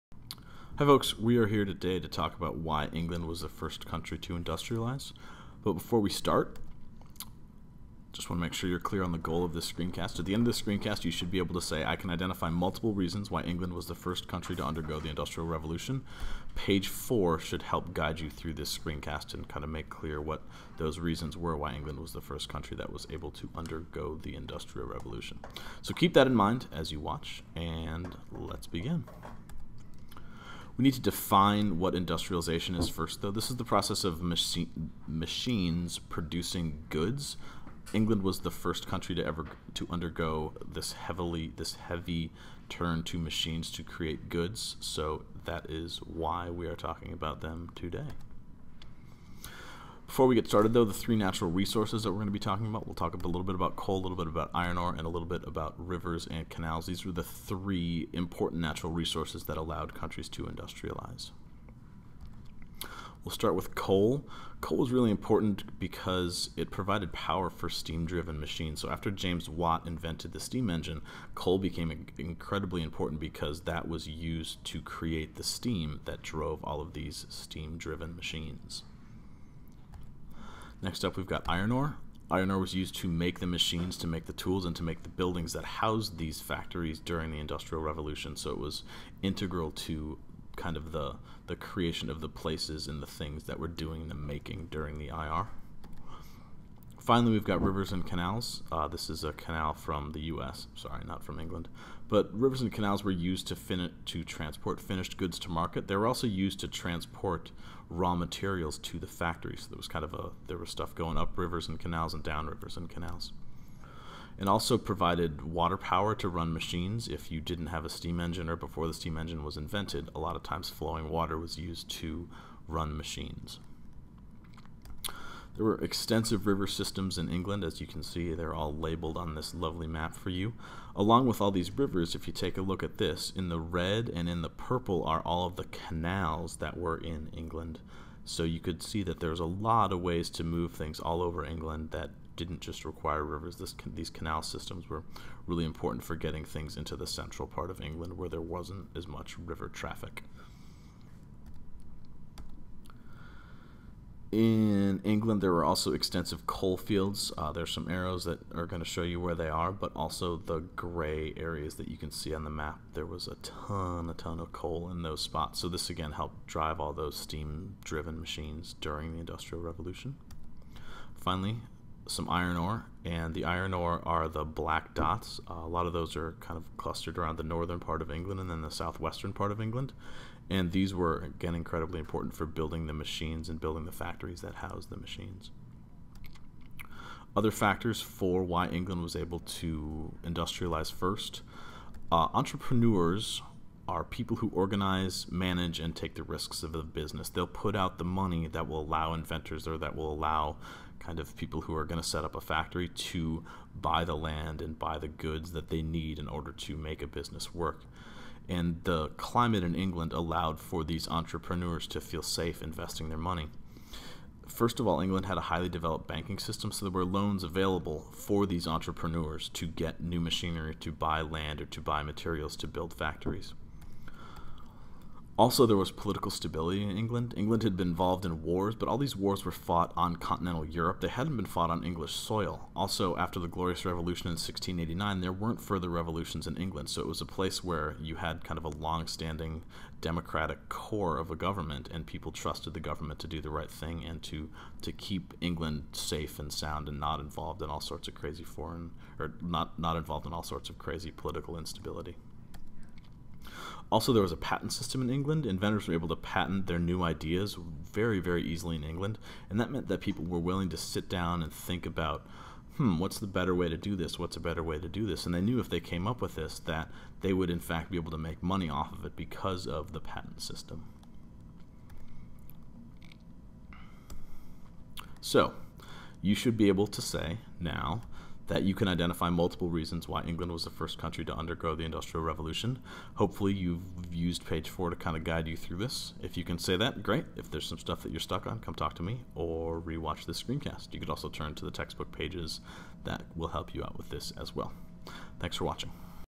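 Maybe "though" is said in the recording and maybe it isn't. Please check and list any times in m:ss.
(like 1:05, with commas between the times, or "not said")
0:33, 0:50.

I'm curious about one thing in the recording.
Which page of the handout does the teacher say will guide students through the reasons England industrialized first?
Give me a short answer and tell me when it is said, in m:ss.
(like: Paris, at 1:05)
Page 4, at 0:16.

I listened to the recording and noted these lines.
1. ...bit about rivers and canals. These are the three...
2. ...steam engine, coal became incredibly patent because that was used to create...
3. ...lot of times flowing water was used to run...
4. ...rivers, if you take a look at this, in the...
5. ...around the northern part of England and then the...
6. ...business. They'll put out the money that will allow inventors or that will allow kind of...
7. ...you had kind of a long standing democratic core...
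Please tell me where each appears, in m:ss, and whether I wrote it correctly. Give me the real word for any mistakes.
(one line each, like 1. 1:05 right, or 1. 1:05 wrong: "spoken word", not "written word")
1. 0:55 right
2. 1:10 wrong: "important", not "patent"
3. 2:00 right
4. 2:11 right
5. 2:57 right
6. 3:16 right
7. 3:58 right.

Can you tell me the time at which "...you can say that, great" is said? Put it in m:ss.
4:46.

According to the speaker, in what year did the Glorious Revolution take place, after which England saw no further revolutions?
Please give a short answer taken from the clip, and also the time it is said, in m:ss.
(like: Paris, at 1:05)
1689, at 3:54.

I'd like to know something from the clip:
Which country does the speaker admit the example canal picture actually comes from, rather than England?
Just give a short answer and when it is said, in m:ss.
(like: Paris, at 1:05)
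U.S., at 1:40.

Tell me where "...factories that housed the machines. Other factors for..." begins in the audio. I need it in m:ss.
3:03.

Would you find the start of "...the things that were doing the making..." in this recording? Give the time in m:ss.
1:33.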